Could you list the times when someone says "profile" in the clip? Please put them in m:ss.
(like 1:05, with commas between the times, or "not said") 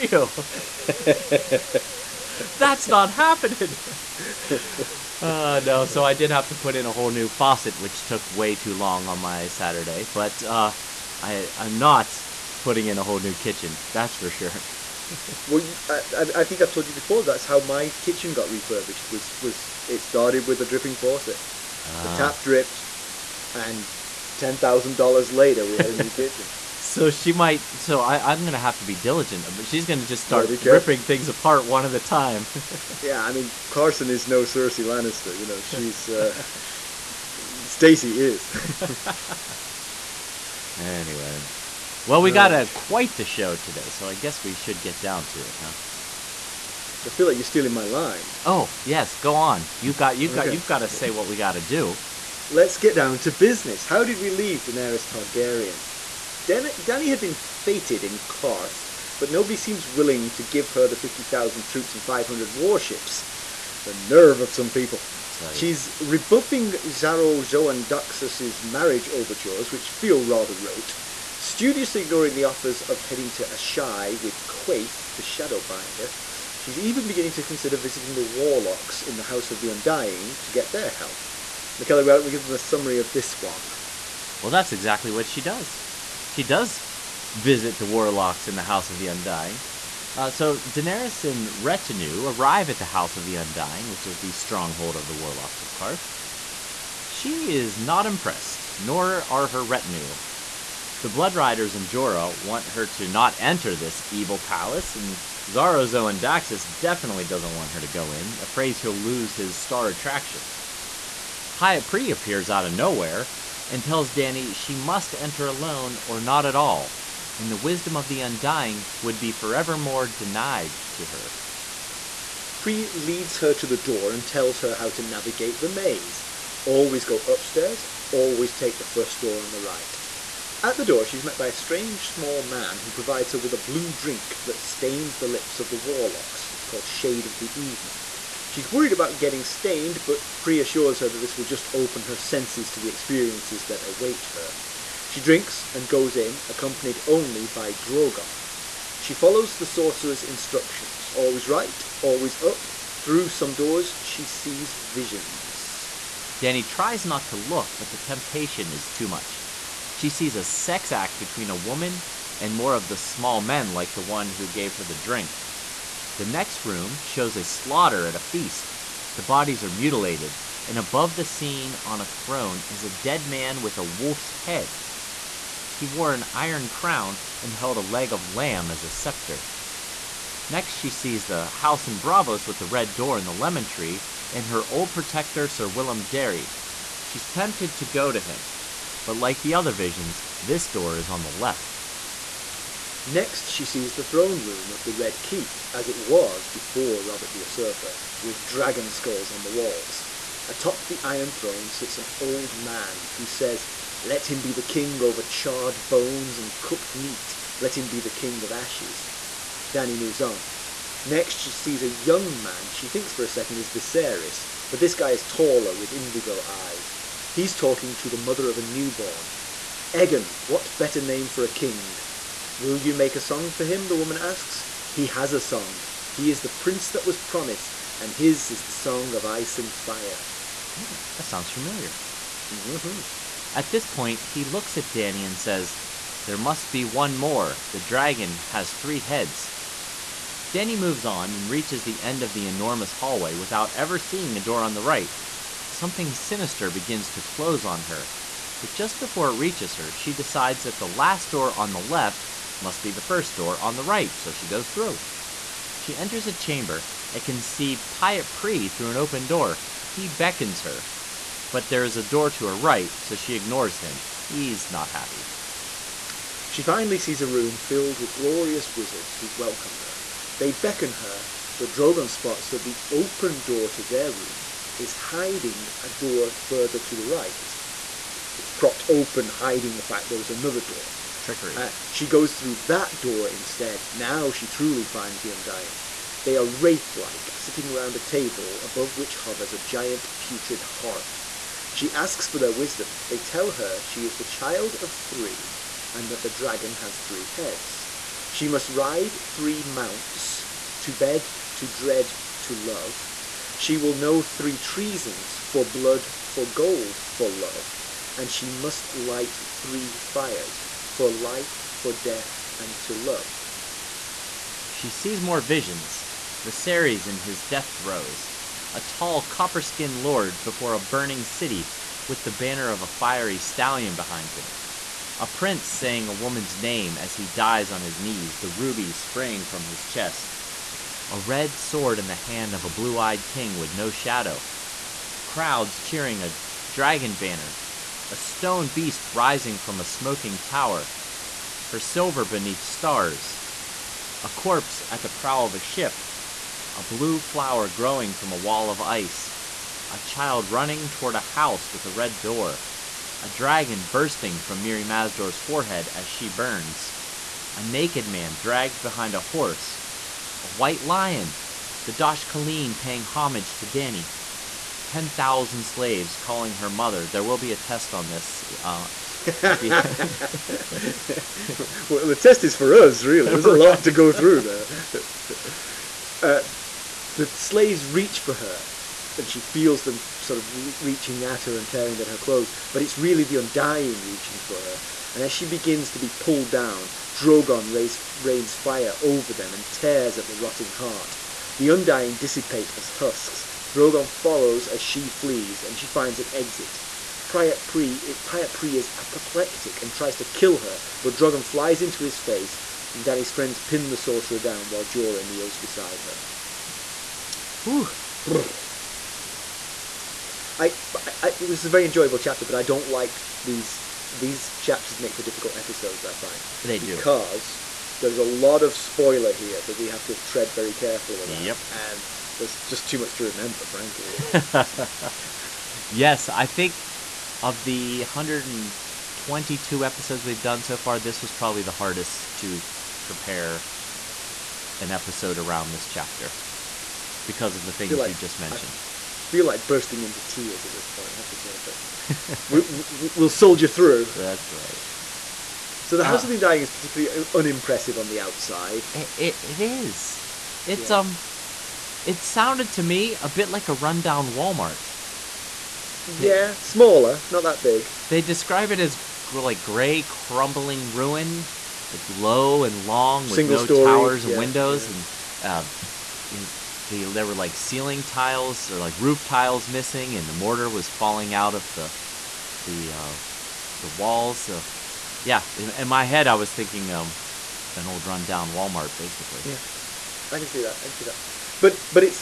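not said.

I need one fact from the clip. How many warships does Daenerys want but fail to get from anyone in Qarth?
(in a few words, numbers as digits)
500.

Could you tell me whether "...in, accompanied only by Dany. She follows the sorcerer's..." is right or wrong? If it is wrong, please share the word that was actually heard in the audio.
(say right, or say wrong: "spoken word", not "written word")
wrong: "Drogon", not "Dany".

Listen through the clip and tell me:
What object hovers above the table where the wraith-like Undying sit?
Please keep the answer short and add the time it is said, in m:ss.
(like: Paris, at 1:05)
A giant putrid heart, at 4:49.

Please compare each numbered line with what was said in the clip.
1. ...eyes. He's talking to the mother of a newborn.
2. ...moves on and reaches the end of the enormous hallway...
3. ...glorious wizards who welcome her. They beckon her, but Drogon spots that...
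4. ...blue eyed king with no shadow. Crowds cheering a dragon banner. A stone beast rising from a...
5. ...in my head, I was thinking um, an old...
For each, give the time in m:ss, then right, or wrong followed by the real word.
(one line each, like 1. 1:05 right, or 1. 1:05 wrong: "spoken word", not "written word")
1. 3:36 right
2. 4:00 right
3. 4:28 right
4. 5:32 right
5. 7:55 right.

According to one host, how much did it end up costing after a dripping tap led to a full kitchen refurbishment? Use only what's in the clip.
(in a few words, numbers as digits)
$10,000.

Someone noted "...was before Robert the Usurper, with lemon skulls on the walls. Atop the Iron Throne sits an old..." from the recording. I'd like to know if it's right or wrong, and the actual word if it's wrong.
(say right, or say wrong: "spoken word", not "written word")
wrong: "dragon", not "lemon".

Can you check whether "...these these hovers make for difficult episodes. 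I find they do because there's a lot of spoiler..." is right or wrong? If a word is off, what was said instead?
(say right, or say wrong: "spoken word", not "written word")
wrong: "chapters", not "hovers".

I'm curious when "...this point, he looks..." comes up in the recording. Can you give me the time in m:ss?
3:53.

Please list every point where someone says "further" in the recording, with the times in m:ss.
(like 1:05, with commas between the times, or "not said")
4:36.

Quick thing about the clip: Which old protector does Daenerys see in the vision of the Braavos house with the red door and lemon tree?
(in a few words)
Sir Willem Darry.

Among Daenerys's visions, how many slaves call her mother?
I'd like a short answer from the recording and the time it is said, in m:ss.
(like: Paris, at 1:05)
10,000, at 6:04.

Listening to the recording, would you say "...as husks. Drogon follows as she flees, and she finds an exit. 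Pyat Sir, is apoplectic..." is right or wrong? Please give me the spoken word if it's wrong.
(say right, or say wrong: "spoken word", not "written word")
wrong: "Pree", not "Sir".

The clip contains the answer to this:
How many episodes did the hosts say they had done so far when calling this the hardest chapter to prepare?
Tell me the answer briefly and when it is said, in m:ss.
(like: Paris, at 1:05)
122, at 7:08.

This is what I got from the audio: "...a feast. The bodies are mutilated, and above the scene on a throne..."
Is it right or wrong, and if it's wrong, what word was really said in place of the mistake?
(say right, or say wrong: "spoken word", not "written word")
right.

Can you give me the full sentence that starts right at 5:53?
A dragon bursting from Mirri Maz Duur's forehead as she burns.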